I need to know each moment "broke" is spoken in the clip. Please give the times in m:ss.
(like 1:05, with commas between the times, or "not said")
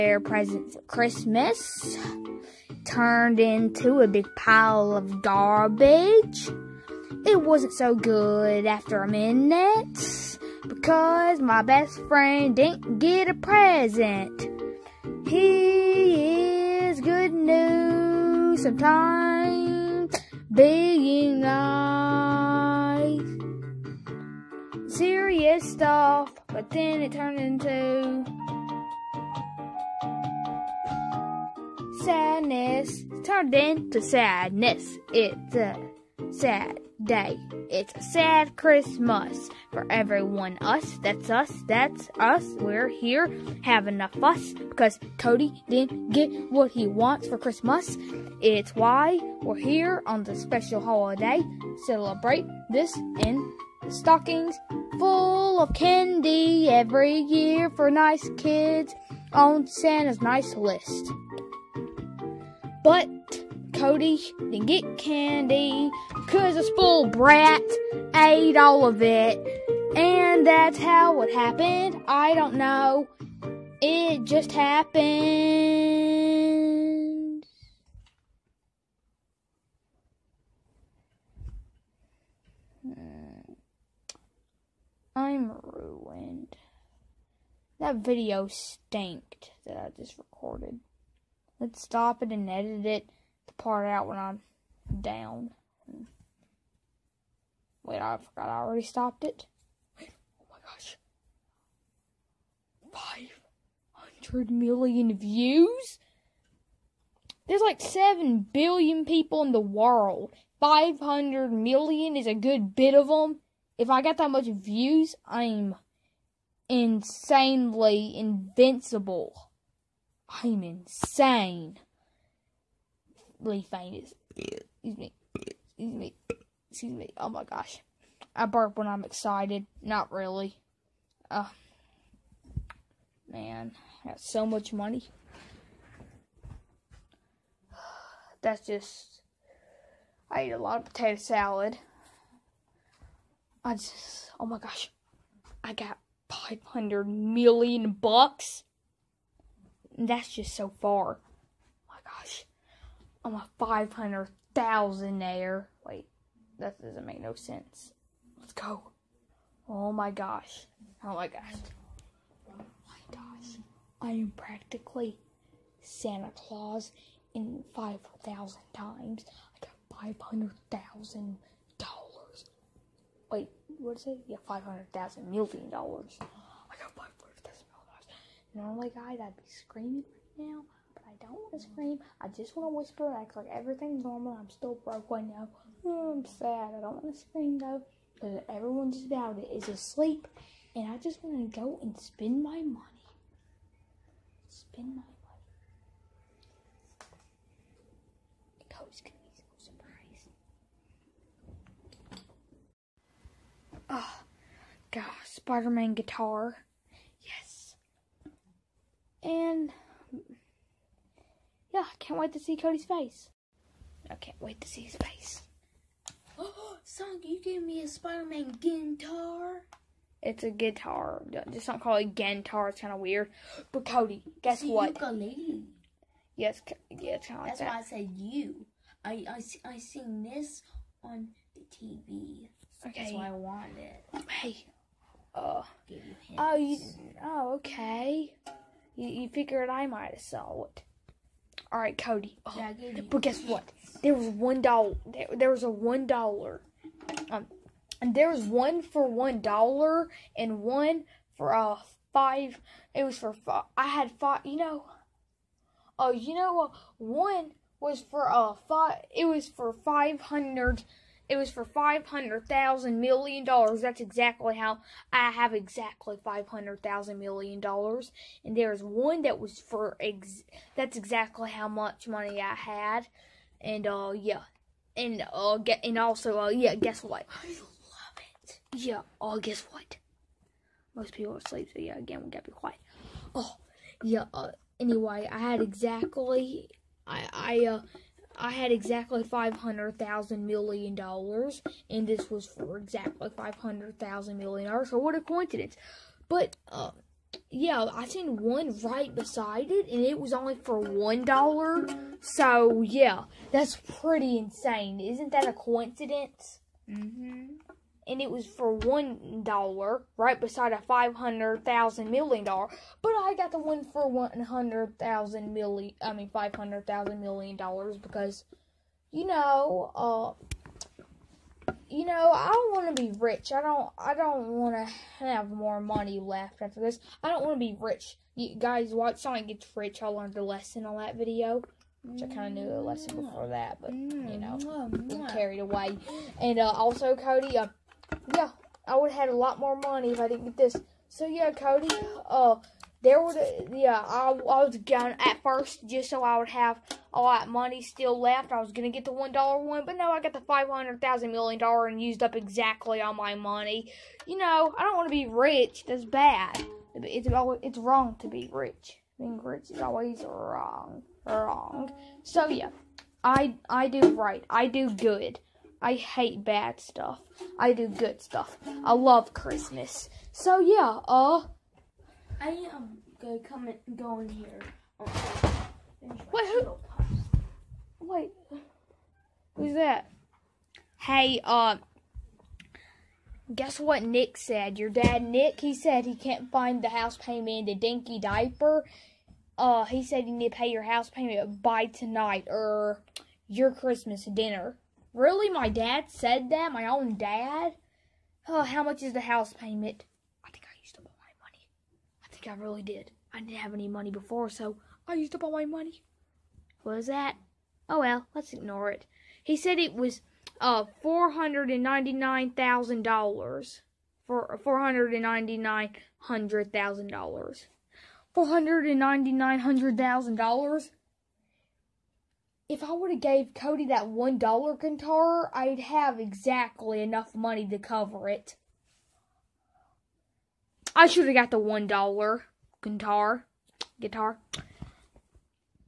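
3:04.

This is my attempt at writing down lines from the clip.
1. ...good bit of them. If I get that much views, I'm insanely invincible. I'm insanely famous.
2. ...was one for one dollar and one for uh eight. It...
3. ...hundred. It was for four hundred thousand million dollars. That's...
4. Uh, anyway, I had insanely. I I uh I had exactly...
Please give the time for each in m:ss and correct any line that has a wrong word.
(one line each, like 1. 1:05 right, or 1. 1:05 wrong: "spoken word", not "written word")
1. 1:52 right
2. 4:08 wrong: "five", not "eight"
3. 4:20 wrong: "five", not "four"
4. 4:44 wrong: "exactly", not "insanely".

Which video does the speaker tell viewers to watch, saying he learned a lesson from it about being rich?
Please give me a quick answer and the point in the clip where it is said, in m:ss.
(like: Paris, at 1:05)
Sonic Gets Rich, at 5:29.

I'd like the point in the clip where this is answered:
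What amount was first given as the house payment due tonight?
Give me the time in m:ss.
6:51.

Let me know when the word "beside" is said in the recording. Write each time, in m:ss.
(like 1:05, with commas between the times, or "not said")
4:59, 5:10.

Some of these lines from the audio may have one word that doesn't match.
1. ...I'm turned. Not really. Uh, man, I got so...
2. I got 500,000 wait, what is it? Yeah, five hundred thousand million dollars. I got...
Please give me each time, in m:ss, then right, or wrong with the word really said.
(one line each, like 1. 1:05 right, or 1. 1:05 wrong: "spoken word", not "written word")
1. 2:08 wrong: "excited", not "turned"
2. 2:49 right.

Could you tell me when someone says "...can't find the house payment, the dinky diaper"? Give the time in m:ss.
6:26.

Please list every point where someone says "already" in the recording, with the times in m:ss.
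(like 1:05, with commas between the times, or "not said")
1:38.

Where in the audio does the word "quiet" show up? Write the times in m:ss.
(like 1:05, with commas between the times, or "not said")
4:42.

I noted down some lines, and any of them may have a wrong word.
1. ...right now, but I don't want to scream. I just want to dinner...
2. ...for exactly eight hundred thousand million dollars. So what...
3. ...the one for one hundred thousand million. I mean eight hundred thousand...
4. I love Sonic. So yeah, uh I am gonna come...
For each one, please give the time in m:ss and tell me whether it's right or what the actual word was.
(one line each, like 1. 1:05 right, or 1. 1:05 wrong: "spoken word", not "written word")
1. 3:00 wrong: "whisper", not "dinner"
2. 4:52 wrong: "five", not "eight"
3. 5:13 wrong: "five", not "eight"
4. 6:08 wrong: "Christmas", not "Sonic".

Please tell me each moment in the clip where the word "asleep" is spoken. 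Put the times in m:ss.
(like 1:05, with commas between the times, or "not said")
3:09, 4:41.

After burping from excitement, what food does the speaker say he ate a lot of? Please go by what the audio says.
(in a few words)
potato salad.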